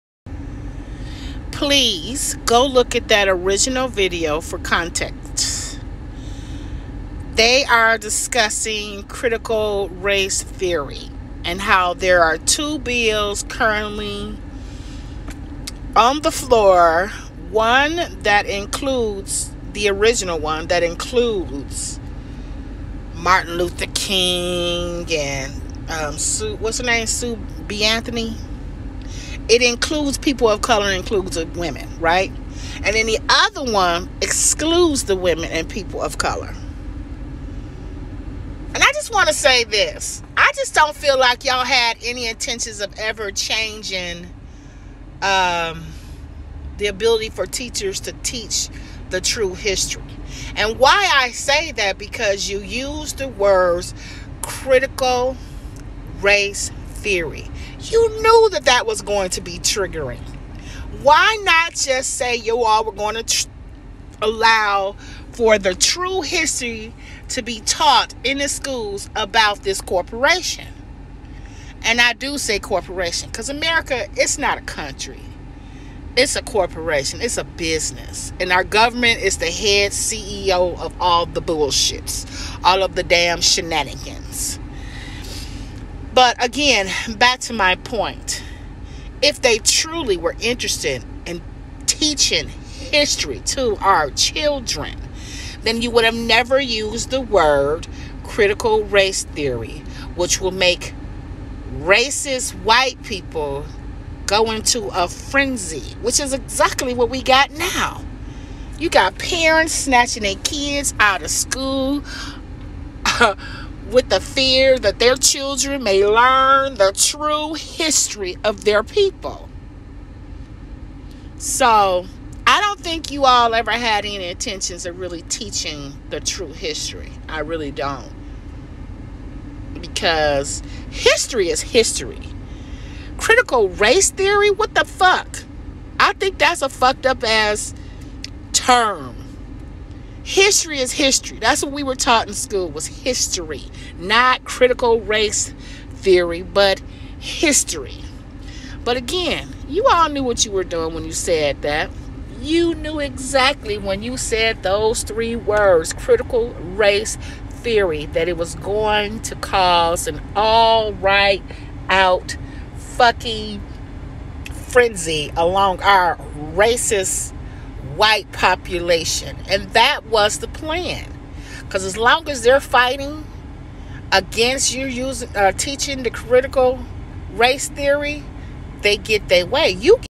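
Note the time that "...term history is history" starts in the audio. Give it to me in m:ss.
2:18.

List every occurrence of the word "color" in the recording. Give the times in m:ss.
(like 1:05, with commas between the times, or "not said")
0:30, 0:36.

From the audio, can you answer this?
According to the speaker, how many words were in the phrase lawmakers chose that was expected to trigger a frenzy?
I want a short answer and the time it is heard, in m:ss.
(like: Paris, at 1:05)
3, at 2:35.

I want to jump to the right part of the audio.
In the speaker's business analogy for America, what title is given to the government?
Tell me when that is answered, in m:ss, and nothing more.
1:19.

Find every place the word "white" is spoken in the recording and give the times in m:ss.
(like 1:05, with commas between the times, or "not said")
1:42, 2:47.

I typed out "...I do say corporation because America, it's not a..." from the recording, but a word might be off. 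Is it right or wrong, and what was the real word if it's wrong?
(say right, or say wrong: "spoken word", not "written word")
right.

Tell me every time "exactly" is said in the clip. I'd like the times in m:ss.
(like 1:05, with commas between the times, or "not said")
1:46, 2:32.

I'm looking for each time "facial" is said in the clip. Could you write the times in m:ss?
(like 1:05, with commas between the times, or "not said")
not said.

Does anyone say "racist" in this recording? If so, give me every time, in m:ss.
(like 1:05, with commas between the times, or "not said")
1:41, 2:46.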